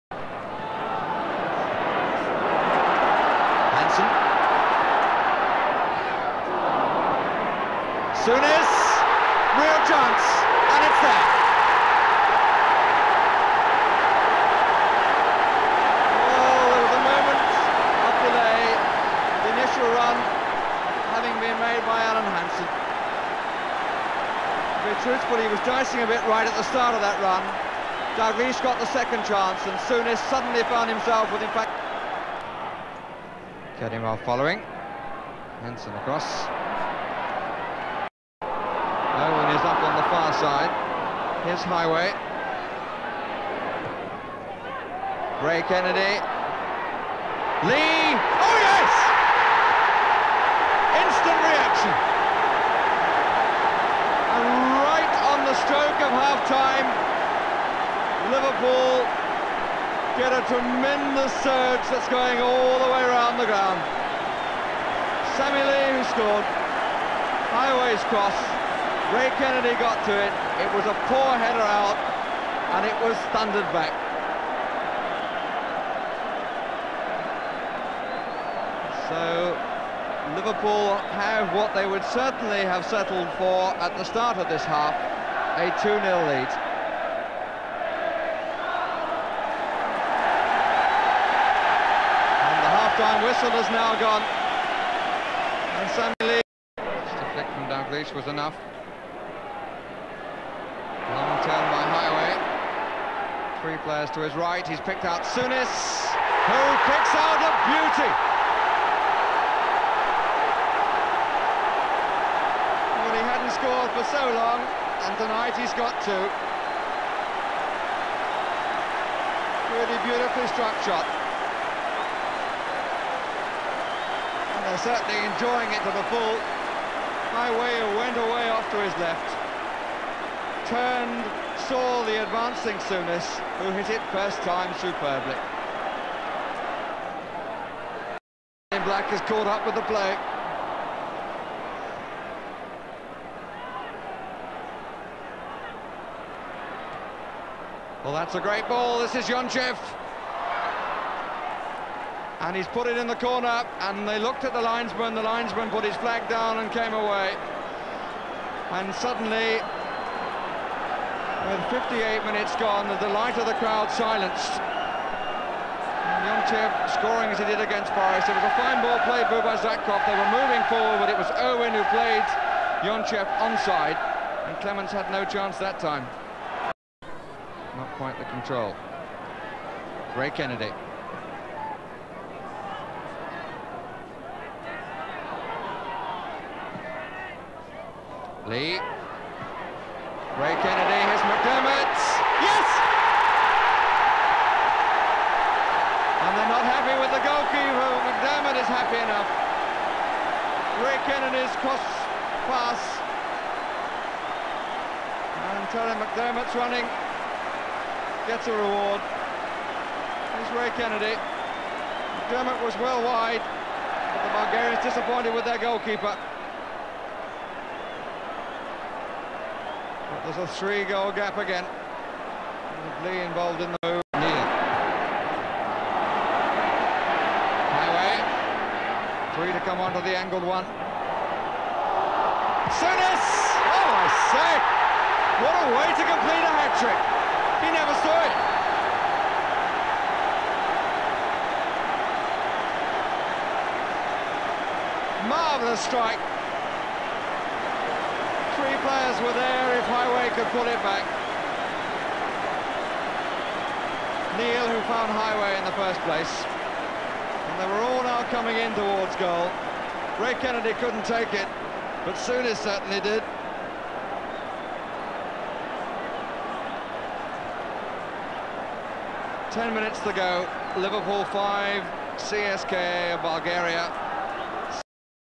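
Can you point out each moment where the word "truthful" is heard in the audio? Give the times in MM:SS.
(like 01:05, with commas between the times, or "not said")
00:25.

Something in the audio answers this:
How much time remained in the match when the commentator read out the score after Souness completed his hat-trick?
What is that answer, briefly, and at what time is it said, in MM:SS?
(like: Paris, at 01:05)
10 minutes, at 04:29.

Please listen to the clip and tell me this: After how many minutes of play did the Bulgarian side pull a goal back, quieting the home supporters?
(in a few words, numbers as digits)
58.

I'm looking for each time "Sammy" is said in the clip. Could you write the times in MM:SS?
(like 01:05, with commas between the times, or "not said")
01:05, 01:35.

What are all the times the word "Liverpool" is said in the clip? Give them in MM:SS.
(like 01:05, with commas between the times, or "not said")
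00:58, 01:20, 04:30.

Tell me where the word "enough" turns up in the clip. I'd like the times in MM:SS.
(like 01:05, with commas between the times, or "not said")
01:38, 03:18.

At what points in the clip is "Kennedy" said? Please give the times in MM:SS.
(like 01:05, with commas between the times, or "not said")
00:45, 01:09, 03:00, 03:10, 03:21, 03:30, 04:20.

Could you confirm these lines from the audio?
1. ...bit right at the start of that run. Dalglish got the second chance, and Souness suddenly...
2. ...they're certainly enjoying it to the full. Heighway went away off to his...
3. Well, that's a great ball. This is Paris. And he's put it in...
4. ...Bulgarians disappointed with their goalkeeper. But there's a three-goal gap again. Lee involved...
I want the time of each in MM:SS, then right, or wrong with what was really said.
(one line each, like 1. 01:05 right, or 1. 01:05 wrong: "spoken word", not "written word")
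1. 00:26 right
2. 02:04 right
3. 02:28 wrong: "Yonchev", not "Paris"
4. 03:34 right.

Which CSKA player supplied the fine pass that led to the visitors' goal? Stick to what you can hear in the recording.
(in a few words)
Zakhov.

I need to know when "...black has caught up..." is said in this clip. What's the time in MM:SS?
02:18.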